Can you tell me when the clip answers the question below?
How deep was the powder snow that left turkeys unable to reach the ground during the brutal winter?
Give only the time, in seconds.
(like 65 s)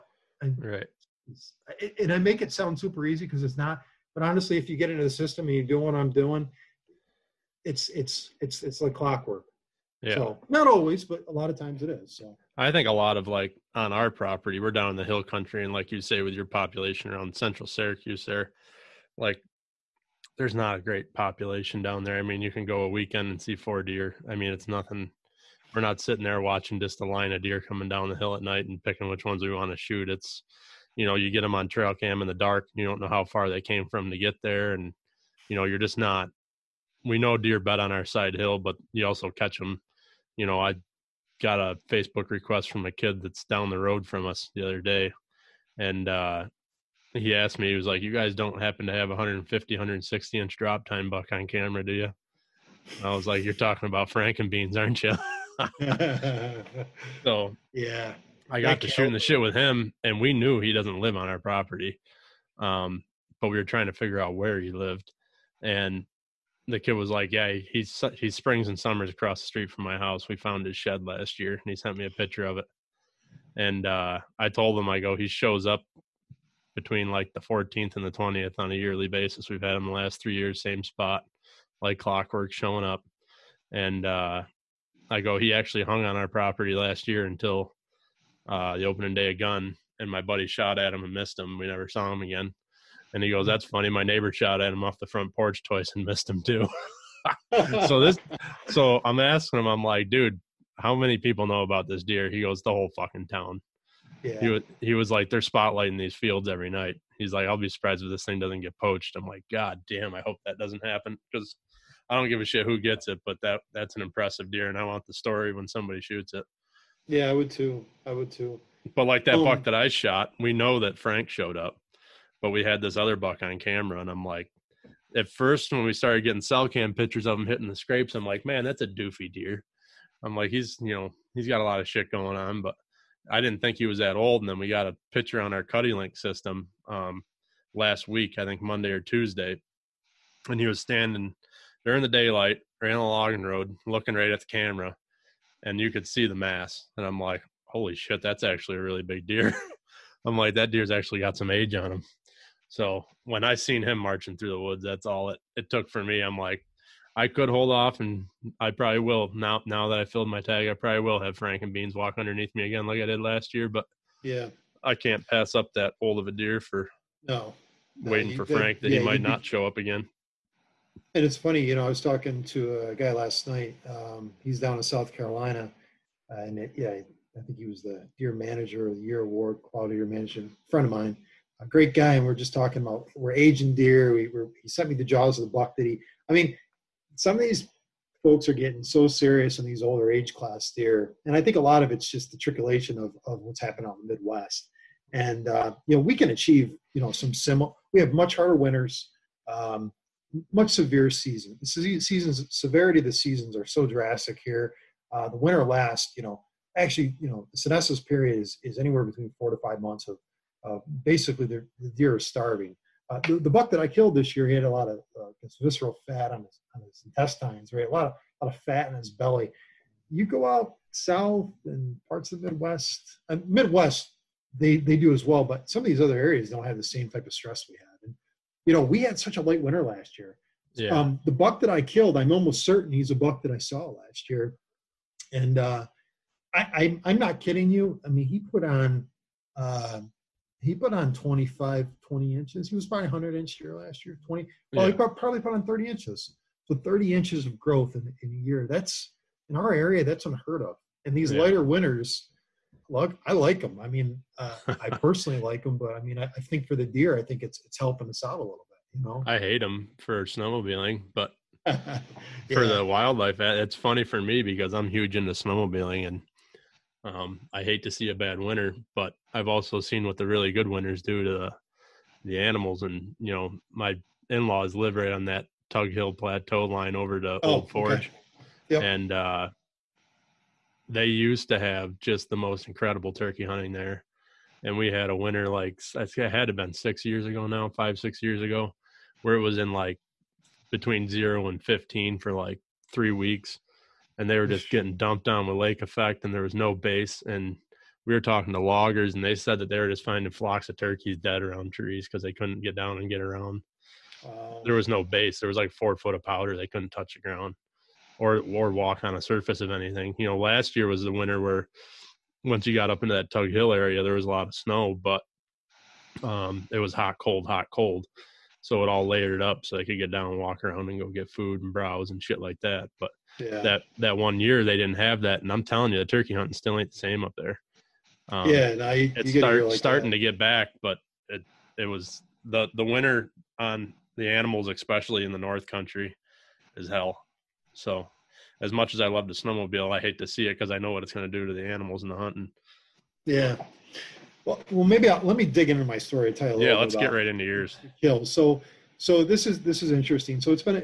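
305 s.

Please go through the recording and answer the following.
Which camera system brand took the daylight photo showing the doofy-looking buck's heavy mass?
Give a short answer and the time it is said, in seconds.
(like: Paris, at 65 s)
CuddeLink, at 135 s.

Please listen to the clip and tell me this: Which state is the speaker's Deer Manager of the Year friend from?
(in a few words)
South Carolina.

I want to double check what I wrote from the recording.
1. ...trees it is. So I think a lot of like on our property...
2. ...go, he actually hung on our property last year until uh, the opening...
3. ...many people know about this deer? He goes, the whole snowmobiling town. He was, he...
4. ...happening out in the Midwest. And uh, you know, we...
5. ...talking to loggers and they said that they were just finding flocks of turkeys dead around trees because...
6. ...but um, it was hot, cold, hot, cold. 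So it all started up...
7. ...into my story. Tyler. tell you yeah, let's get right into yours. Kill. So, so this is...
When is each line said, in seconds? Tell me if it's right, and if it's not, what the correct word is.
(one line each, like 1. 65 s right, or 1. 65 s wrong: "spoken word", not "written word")
1. 11 s wrong: "times", not "trees"
2. 85 s right
3. 100 s wrong: "fucking", not "snowmobiling"
4. 193 s right
5. 298 s right
6. 314 s wrong: "layered", not "started"
7. 345 s right.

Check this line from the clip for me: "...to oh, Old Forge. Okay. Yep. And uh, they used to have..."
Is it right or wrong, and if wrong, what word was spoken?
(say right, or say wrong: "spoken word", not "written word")
right.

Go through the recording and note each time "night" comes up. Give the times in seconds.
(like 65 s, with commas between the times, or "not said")
28 s, 106 s, 173 s.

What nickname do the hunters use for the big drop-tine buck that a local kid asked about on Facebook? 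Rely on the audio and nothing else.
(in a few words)
Frankenbeans.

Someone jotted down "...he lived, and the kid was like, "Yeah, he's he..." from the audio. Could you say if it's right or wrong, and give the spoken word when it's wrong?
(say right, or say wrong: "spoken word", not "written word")
right.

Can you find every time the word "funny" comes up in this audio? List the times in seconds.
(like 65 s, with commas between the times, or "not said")
93 s, 171 s, 263 s.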